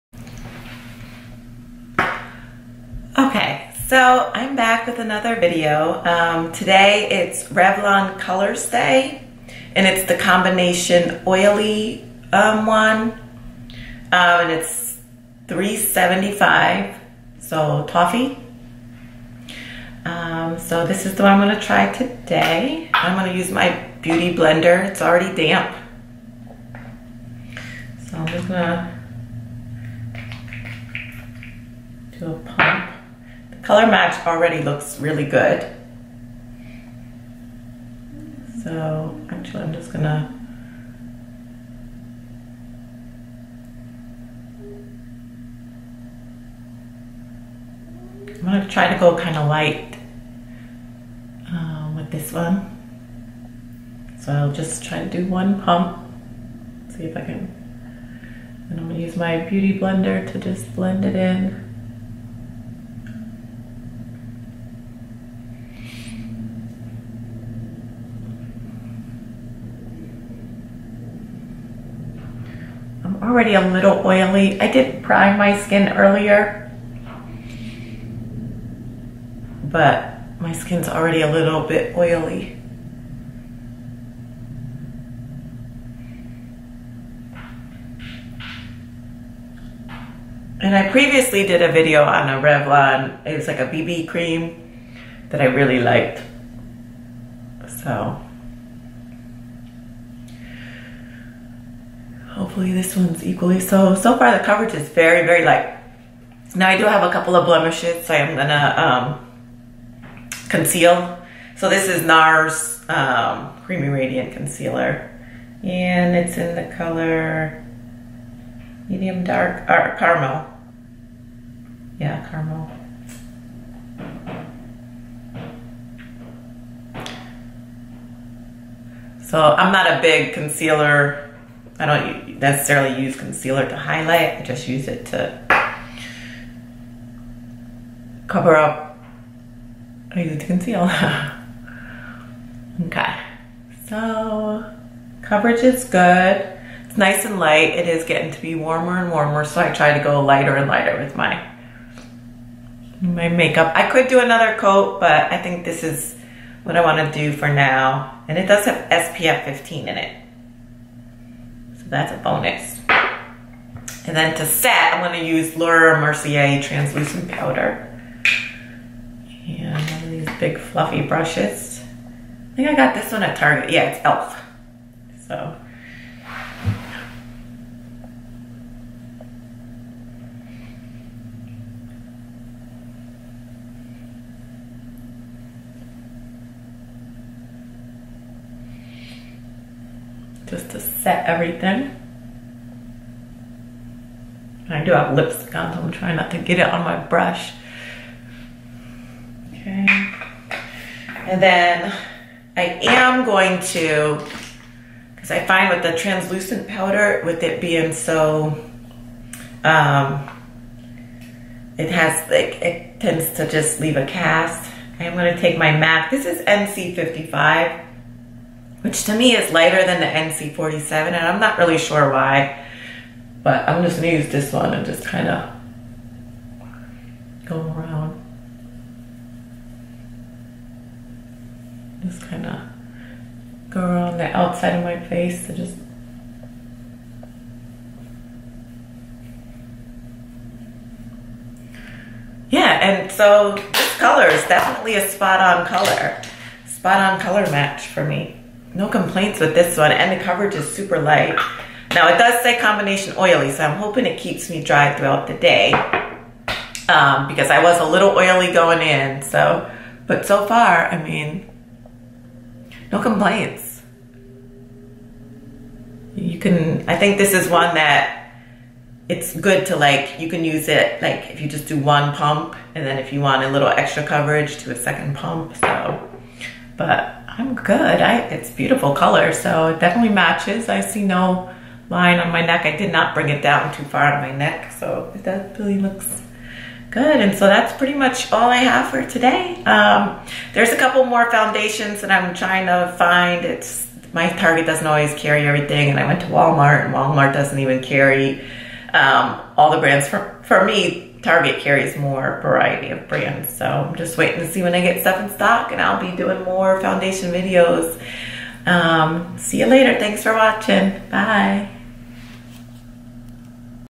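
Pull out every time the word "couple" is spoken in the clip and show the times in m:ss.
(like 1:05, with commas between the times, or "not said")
1:47, 4:50.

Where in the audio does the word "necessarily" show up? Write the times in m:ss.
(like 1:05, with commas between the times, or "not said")
2:12.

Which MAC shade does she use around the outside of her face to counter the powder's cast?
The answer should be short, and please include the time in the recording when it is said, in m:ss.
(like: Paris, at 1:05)
NC55, at 3:36.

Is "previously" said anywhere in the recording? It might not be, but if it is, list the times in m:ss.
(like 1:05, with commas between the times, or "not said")
1:30.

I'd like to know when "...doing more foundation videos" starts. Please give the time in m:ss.
5:06.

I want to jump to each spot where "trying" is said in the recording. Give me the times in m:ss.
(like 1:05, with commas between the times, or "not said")
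3:15, 4:52.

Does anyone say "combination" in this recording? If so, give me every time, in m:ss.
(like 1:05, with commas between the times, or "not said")
0:10, 4:12.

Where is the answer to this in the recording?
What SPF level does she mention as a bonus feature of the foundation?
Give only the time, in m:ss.
2:38.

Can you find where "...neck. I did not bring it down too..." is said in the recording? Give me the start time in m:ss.
4:42.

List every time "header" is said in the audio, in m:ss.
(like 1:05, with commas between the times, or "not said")
not said.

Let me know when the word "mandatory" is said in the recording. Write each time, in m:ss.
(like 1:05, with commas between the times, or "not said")
not said.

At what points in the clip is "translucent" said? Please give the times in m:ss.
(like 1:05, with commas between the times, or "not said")
2:46, 3:25.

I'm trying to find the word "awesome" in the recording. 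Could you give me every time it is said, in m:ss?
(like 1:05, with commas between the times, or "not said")
not said.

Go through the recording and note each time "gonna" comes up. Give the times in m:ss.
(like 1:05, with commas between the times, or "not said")
0:39, 0:48, 0:58, 1:48, 2:45, 3:43.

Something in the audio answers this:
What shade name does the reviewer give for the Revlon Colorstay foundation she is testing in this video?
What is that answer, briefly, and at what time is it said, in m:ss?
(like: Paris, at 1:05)
Toffee, at 0:17.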